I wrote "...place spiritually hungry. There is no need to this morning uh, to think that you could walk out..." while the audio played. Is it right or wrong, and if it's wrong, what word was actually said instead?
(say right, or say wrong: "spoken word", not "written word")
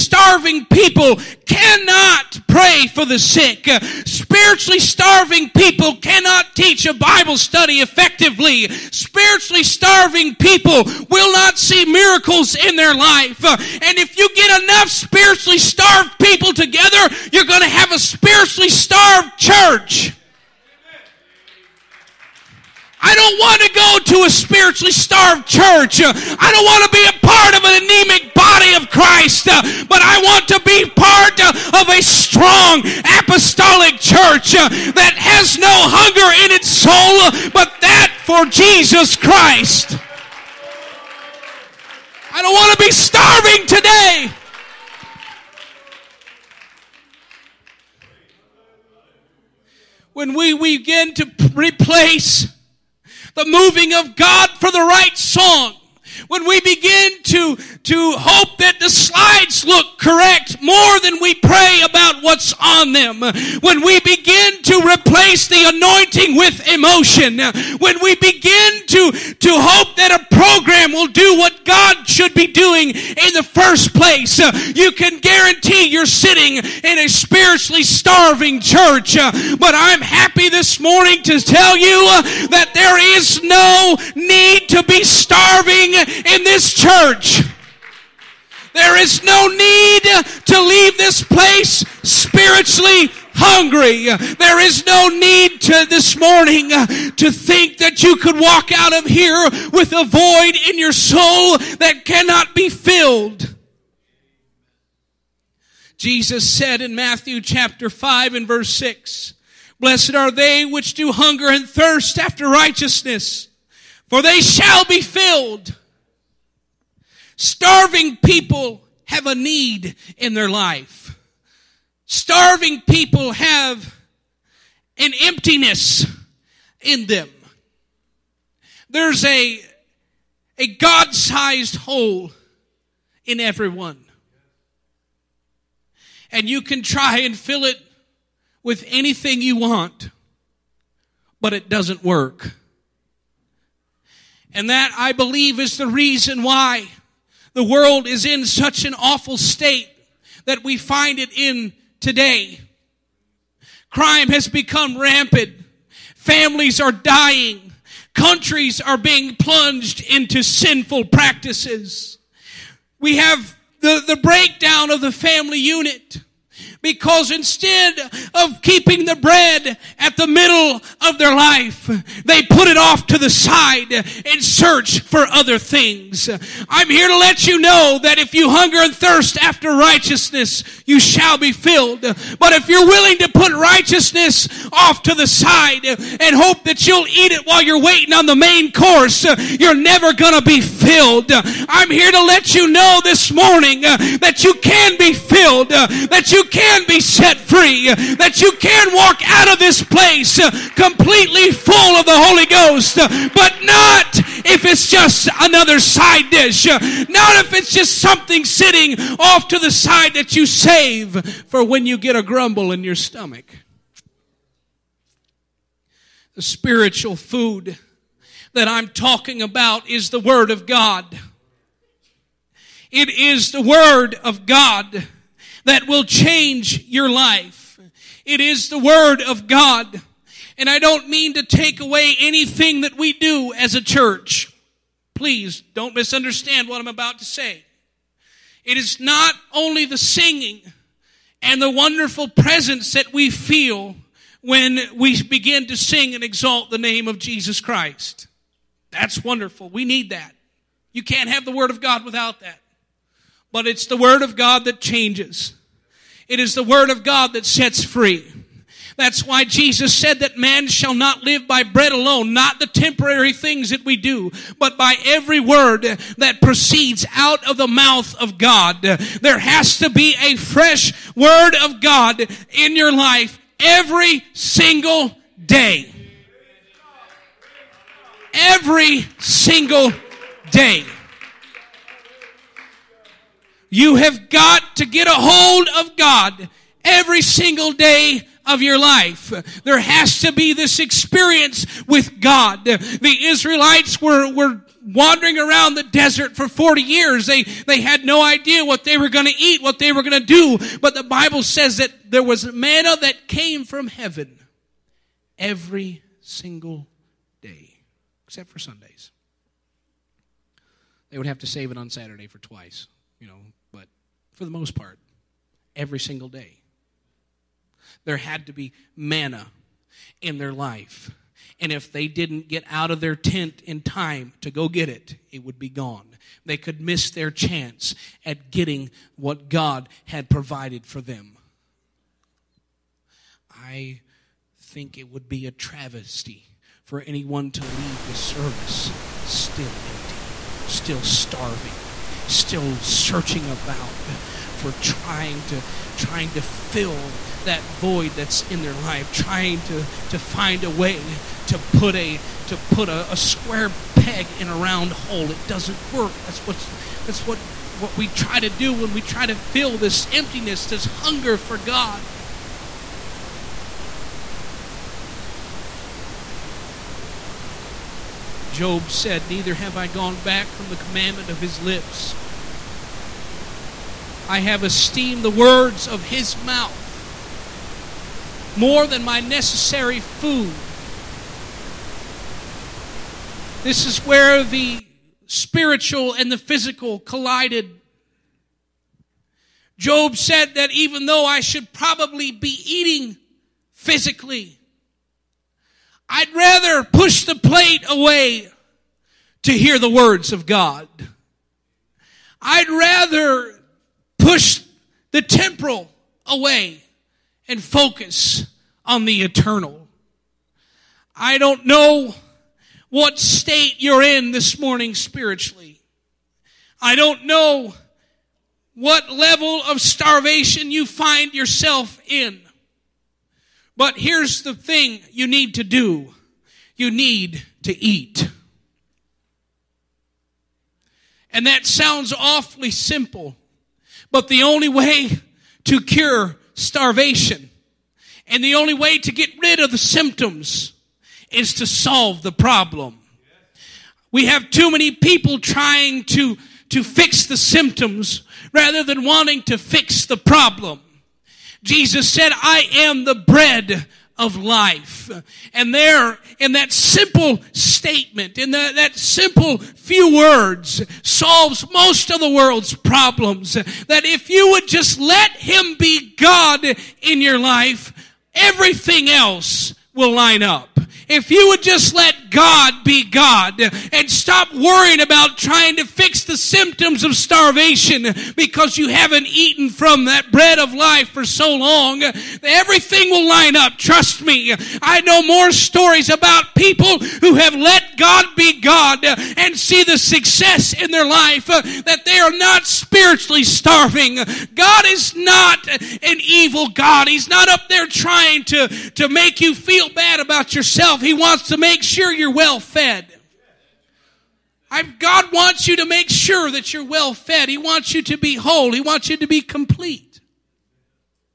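right.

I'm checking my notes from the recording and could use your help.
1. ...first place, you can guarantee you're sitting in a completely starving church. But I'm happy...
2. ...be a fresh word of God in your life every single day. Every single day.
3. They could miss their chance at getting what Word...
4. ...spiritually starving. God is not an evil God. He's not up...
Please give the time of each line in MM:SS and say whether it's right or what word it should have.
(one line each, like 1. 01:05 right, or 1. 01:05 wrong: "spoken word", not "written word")
1. 01:13 wrong: "spiritually", not "completely"
2. 04:29 right
3. 05:26 wrong: "God", not "Word"
4. 08:12 right.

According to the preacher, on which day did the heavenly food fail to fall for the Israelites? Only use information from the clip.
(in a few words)
Sundays.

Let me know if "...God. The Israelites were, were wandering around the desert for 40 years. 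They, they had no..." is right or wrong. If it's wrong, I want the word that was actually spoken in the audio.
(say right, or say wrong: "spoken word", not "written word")
right.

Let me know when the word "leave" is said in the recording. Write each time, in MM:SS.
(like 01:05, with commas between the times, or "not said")
01:30, 05:37.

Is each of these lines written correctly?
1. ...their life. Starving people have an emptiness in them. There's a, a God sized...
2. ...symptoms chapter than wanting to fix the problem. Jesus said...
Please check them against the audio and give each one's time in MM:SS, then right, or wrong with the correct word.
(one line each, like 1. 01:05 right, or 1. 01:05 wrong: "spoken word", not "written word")
1. 02:00 right
2. 07:27 wrong: "rather", not "chapter".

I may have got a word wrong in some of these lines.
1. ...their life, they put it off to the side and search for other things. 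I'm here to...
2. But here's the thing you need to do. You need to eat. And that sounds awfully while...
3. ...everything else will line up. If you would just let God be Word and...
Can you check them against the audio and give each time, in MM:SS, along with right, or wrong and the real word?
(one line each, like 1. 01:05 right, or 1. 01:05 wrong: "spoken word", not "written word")
1. 02:51 right
2. 07:03 wrong: "simple", not "while"
3. 07:48 wrong: "God", not "Word".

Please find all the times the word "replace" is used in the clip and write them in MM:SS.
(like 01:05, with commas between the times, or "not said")
00:51, 01:04.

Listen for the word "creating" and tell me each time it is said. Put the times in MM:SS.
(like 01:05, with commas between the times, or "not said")
not said.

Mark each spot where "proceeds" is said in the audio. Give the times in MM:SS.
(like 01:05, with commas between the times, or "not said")
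04:26.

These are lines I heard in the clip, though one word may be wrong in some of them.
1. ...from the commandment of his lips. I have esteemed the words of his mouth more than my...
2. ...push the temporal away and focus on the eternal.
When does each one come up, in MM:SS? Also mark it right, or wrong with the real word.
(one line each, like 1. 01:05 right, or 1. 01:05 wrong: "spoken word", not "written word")
1. 06:10 right
2. 06:44 right.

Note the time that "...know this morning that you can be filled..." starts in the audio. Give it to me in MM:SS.
03:12.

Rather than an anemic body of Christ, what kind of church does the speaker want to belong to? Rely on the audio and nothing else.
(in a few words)
strong apostolic church.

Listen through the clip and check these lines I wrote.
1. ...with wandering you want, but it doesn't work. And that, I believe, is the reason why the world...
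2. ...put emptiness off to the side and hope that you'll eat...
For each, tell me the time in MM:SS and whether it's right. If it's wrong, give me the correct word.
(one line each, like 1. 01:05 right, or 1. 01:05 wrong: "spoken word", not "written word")
1. 02:18 wrong: "anything", not "wandering"
2. 03:03 wrong: "righteousness", not "emptiness".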